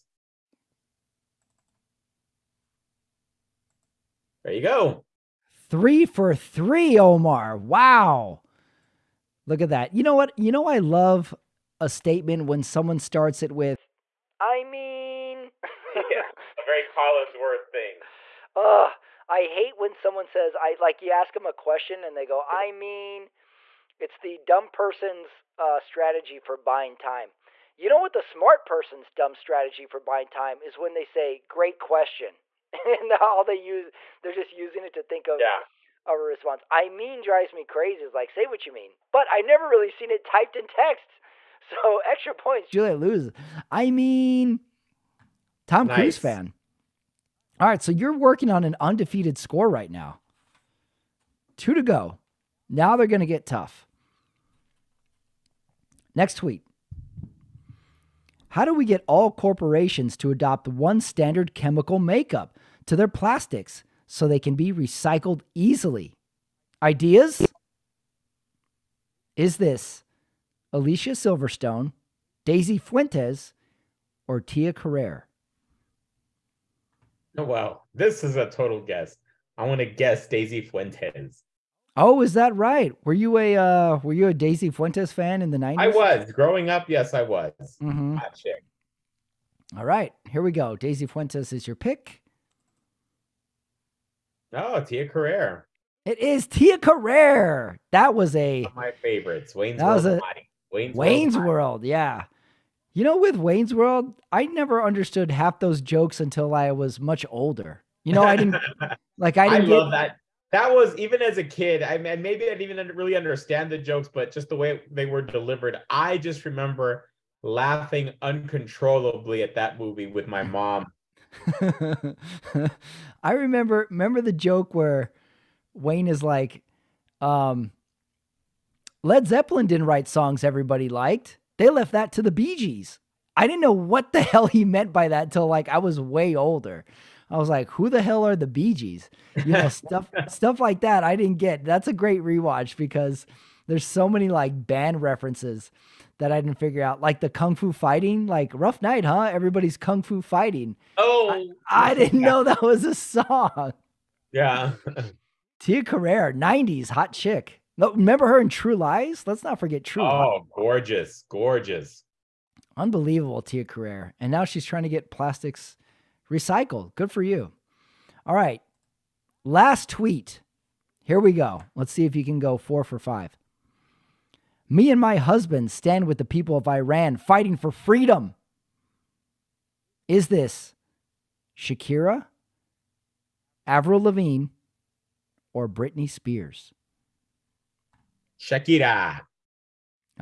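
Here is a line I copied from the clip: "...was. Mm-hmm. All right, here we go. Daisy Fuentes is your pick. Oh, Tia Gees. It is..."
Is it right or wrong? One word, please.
wrong.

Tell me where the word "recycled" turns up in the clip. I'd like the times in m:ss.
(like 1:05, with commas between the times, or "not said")
1:04, 2:46.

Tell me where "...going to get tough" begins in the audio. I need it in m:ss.
0:53.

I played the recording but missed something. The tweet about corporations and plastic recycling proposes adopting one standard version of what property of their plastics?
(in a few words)
Chemical makeup.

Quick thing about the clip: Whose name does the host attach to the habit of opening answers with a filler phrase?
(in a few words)
Collinsworth.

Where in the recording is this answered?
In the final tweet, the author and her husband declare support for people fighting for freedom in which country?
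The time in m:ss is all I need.
2:56.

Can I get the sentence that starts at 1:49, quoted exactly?
I didn't I love get, that.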